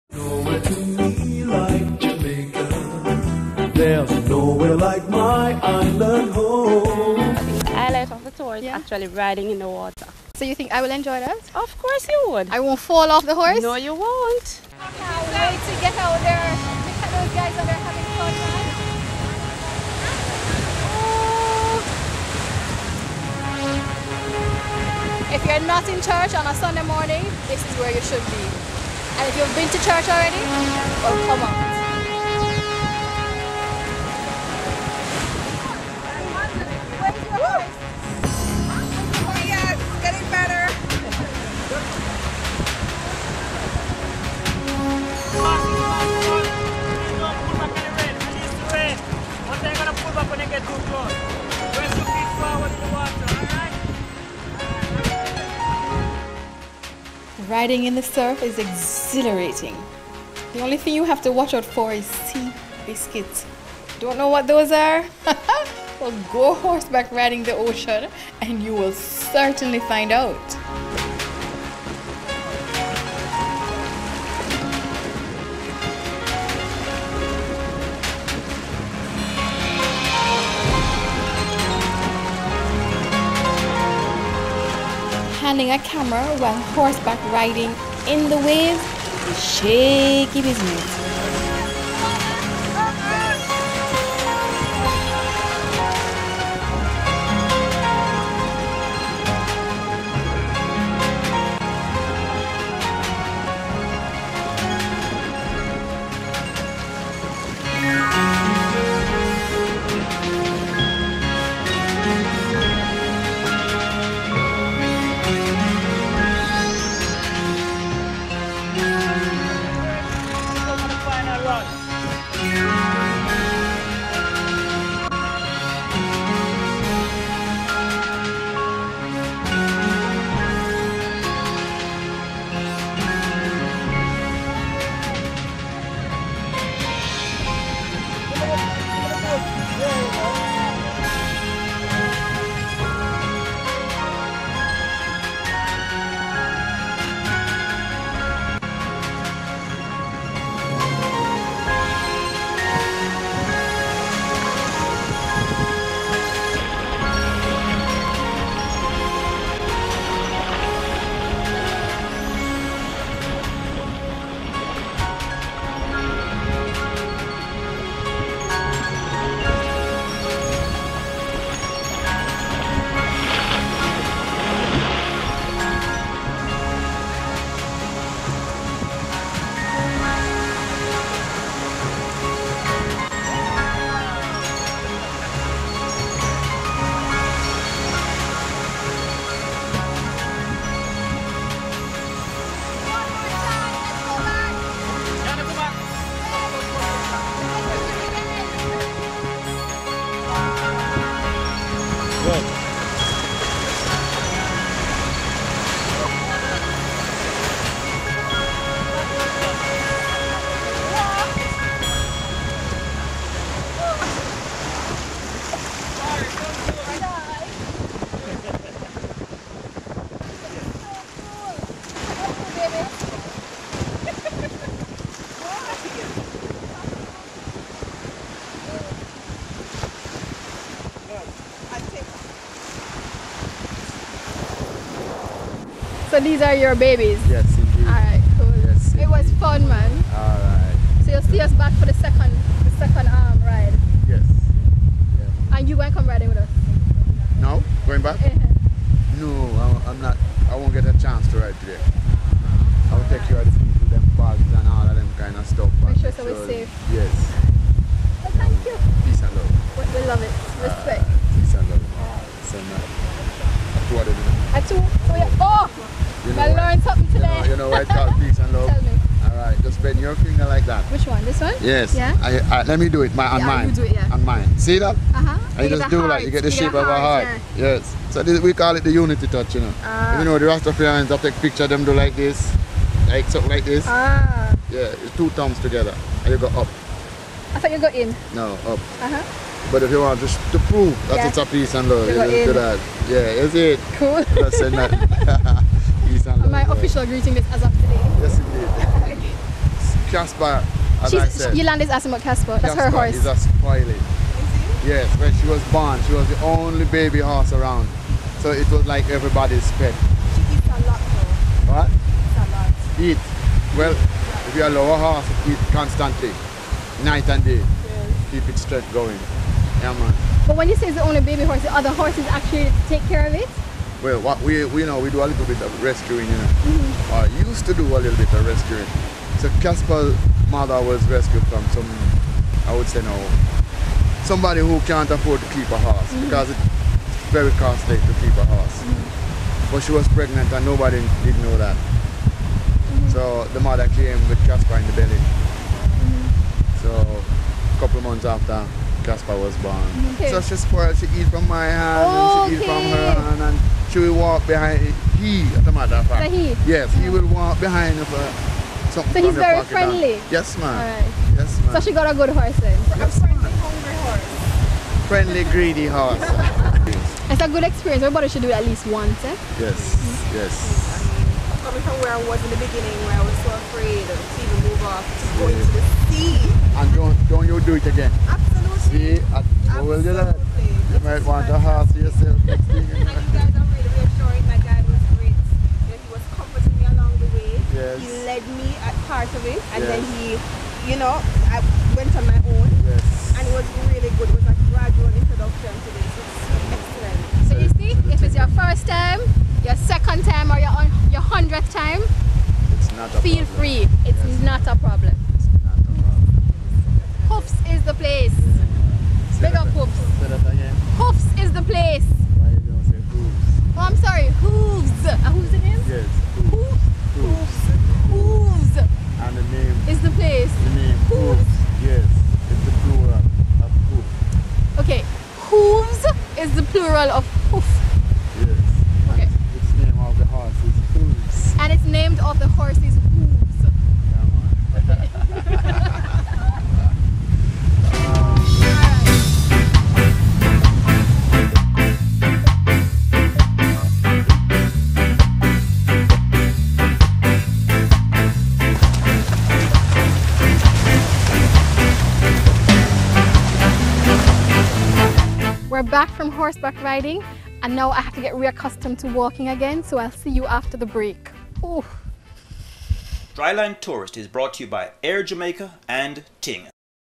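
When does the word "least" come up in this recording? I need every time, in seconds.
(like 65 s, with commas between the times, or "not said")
368 s.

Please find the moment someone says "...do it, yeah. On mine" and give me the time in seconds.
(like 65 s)
273 s.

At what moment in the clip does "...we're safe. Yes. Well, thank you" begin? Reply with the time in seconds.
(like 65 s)
256 s.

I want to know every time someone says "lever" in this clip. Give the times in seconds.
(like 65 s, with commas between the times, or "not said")
not said.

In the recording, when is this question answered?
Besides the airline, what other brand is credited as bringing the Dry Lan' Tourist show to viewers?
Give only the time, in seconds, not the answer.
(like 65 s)
466 s.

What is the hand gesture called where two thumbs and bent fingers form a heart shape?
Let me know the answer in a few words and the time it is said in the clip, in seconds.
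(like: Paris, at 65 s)
Unity touch, at 278 s.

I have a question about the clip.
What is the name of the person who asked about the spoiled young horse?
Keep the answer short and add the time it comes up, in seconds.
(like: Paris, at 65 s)
Yolanda, at 301 s.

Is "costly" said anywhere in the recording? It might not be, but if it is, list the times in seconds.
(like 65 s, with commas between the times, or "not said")
337 s.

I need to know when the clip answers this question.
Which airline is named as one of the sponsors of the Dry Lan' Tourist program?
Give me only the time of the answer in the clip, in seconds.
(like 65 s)
465 s.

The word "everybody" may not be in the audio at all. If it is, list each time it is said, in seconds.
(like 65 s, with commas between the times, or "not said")
309 s, 368 s.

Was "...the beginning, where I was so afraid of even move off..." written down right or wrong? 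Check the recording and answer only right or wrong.
right.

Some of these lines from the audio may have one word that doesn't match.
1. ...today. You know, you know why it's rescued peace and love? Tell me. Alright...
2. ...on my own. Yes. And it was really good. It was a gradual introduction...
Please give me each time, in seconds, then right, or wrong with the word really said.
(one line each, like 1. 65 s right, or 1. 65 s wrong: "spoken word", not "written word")
1. 267 s wrong: "called", not "rescued"
2. 392 s right.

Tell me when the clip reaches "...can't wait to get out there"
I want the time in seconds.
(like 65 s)
14 s.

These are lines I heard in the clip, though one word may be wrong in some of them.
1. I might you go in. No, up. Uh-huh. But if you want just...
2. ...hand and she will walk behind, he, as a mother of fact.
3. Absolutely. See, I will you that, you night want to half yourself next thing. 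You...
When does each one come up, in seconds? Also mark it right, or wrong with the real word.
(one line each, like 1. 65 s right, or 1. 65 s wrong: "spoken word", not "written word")
1. 287 s wrong: "thought", not "might"
2. 353 s wrong: "matter", not "mother"
3. 378 s wrong: "might", not "night".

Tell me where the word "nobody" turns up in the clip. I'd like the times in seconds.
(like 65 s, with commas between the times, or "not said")
340 s.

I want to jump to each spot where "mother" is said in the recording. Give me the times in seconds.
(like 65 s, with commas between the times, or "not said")
330 s, 343 s.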